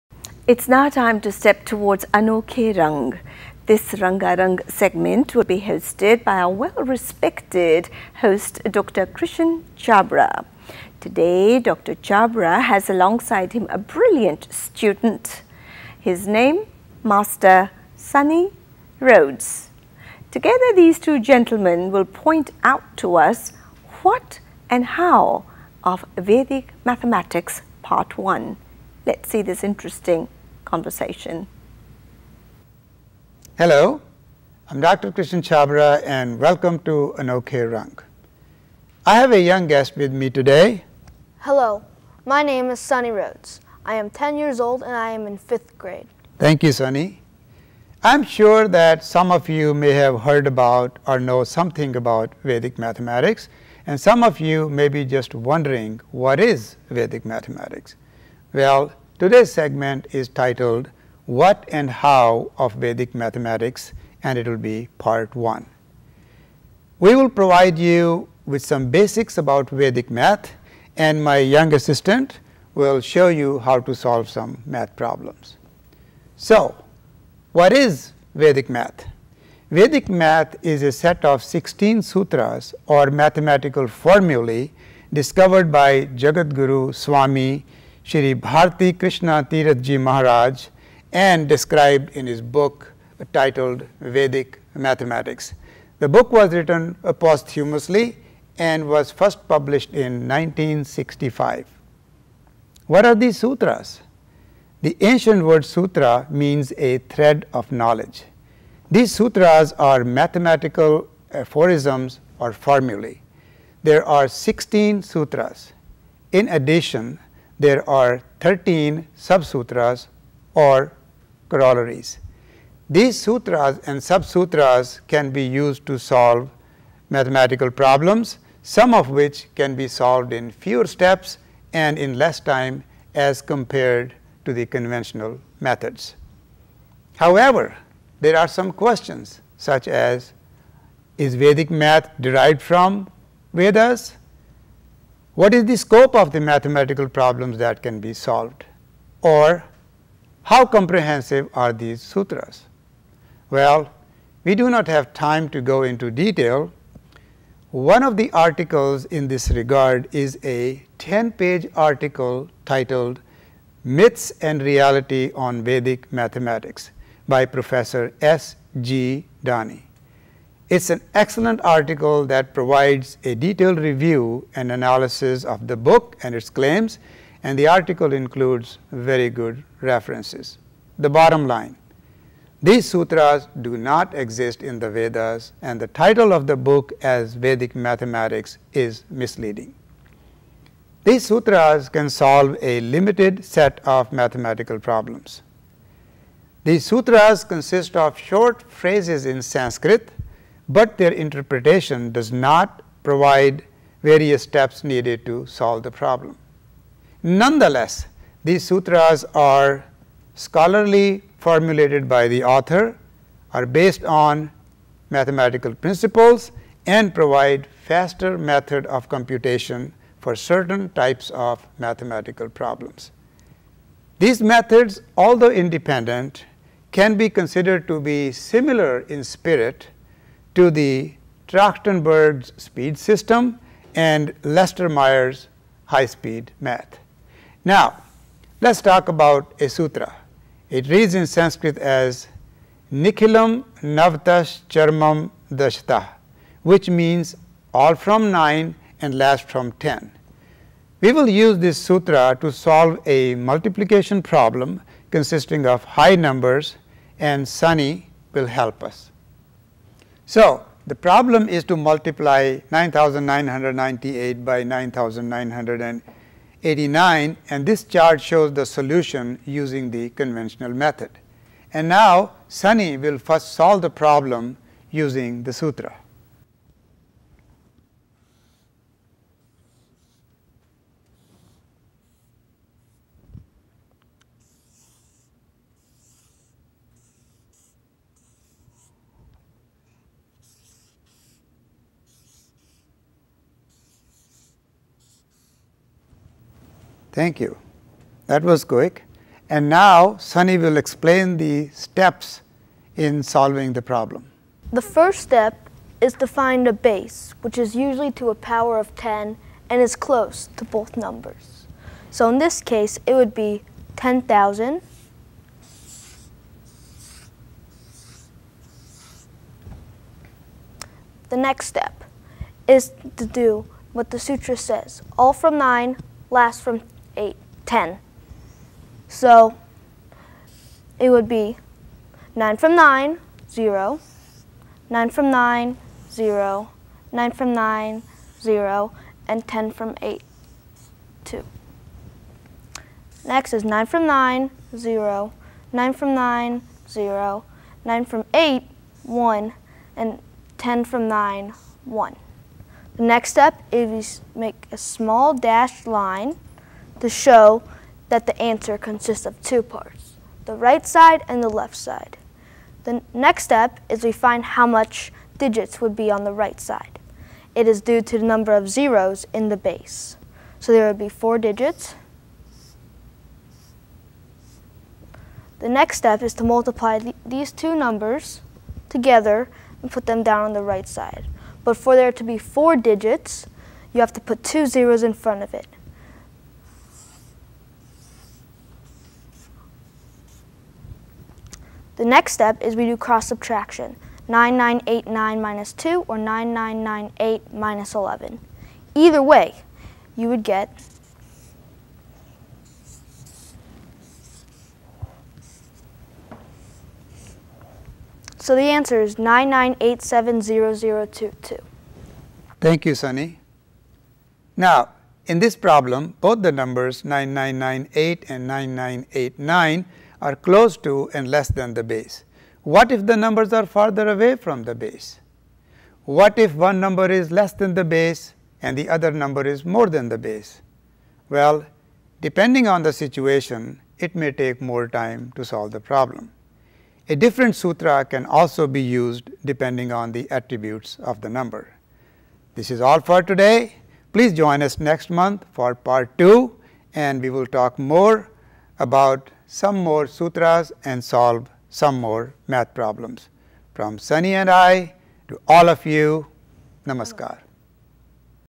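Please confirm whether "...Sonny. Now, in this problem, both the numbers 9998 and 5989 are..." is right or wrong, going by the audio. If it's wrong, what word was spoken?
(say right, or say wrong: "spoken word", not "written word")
wrong: "9989", not "5989".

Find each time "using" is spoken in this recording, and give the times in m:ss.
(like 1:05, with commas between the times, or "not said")
4:29, 4:34.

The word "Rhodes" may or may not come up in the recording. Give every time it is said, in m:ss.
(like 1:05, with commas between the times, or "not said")
0:18, 0:43.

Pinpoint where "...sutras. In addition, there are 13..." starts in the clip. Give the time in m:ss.
1:55.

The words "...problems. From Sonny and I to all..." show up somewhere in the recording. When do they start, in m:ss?
7:32.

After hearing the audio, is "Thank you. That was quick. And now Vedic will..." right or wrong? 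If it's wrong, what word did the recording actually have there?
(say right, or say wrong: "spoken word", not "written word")
wrong: "Sonny", not "Vedic".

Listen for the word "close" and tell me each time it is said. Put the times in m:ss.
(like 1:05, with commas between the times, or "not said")
5:09, 7:00.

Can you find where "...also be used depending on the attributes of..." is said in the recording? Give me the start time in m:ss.
7:18.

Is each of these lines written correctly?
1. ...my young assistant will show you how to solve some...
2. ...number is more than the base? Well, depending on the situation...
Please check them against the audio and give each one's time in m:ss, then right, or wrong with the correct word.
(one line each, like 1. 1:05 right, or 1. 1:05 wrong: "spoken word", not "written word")
1. 1:11 right
2. 7:09 right.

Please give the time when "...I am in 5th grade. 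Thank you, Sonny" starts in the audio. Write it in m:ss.
0:44.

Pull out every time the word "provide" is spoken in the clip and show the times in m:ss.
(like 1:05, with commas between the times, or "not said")
1:07, 2:52, 3:23, 3:37.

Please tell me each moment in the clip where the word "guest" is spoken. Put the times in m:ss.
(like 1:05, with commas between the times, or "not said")
0:39.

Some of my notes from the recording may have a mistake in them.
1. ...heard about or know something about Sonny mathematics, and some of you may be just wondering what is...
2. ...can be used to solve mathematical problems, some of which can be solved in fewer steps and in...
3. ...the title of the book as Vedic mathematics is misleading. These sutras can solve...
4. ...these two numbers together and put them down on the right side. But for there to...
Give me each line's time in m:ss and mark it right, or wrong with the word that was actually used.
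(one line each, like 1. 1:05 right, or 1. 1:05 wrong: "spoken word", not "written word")
1. 0:50 wrong: "Vedic", not "Sonny"
2. 2:05 right
3. 3:05 right
4. 6:17 right.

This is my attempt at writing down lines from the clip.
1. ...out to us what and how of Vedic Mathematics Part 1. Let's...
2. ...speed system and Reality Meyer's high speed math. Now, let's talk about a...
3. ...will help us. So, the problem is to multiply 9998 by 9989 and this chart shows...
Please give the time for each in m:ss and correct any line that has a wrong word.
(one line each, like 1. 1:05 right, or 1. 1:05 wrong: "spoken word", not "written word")
1. 0:22 right
2. 3:52 wrong: "Lester", not "Reality"
3. 4:18 right.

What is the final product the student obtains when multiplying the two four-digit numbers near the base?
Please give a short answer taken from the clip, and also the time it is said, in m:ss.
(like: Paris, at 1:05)
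99870002, at 6:49.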